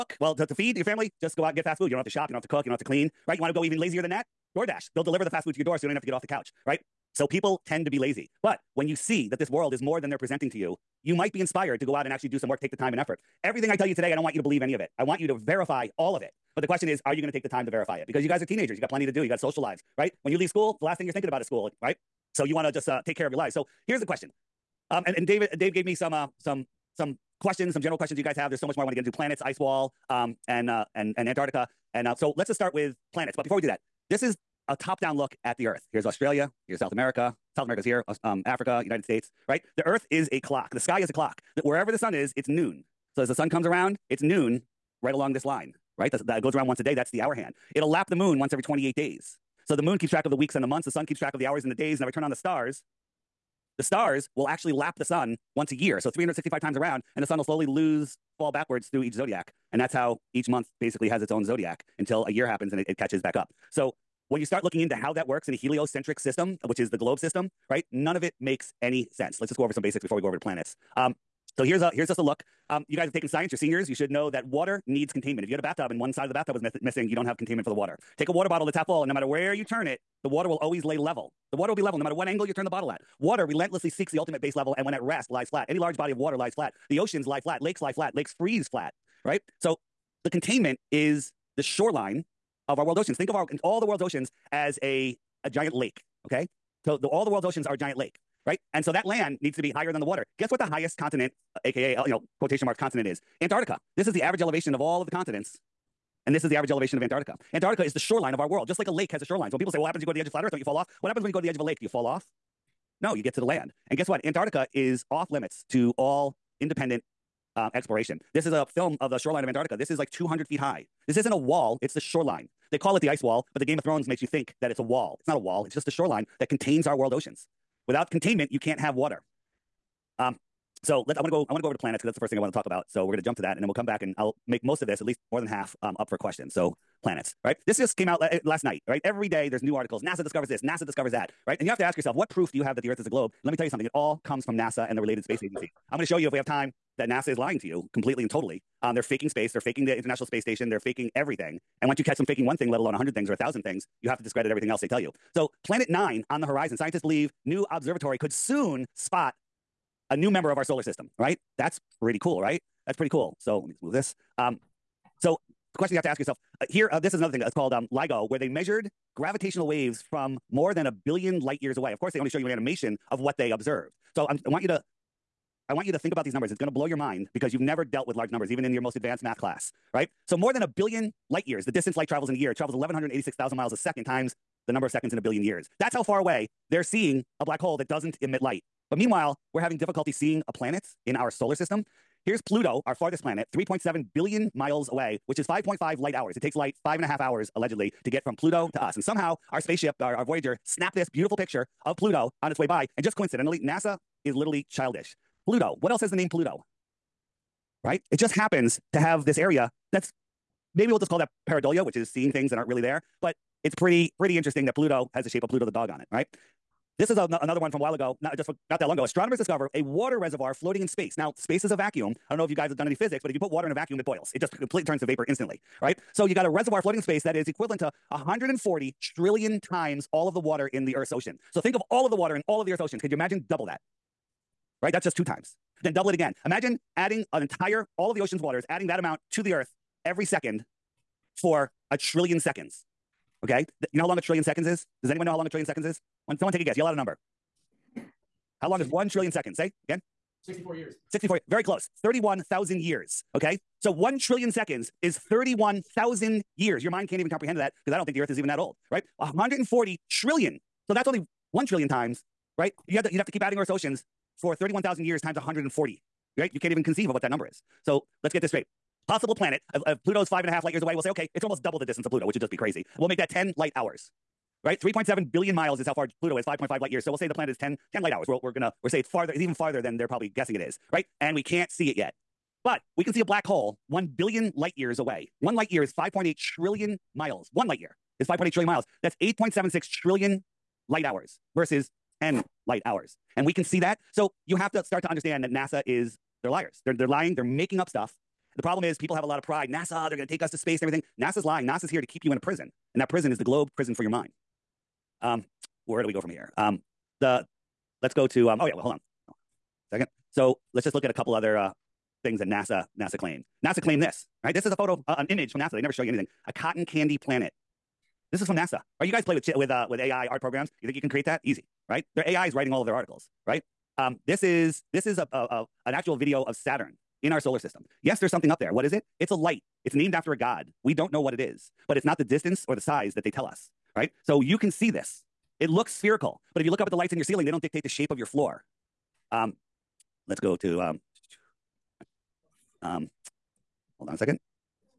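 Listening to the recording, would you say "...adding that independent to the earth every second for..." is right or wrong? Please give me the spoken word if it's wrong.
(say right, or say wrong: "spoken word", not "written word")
wrong: "amount", not "independent".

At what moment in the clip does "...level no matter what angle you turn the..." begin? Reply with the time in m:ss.
1:21.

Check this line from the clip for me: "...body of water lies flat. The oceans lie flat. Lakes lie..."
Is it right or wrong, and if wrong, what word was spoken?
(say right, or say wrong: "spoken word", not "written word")
right.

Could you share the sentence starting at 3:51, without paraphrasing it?
So think of all of the water in all of the Earth's oceans.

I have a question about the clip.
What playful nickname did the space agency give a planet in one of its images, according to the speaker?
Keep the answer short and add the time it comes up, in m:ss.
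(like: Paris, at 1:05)
cotton candy planet, at 5:16.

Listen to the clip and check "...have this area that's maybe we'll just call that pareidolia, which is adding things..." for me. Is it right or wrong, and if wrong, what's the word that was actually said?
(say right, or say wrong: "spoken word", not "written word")
wrong: "seeing", not "adding".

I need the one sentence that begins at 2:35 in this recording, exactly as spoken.
So, Planet Nine on the horizon.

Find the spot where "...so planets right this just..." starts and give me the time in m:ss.
2:16.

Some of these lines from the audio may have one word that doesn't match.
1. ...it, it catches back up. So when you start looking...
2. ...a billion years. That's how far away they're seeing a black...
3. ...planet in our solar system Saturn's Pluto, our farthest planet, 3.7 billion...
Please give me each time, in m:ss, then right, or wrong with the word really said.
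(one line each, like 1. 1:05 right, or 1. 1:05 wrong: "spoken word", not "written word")
1. 1:02 right
2. 3:05 right
3. 3:10 wrong: "Here", not "Saturn".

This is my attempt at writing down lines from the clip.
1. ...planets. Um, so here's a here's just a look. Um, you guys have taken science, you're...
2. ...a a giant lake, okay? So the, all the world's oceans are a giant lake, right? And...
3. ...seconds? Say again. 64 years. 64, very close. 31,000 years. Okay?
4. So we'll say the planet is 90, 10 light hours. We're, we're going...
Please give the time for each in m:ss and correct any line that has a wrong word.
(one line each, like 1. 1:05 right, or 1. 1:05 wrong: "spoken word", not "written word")
1. 1:10 right
2. 1:34 right
3. 4:09 right
4. 4:37 wrong: "10", not "90".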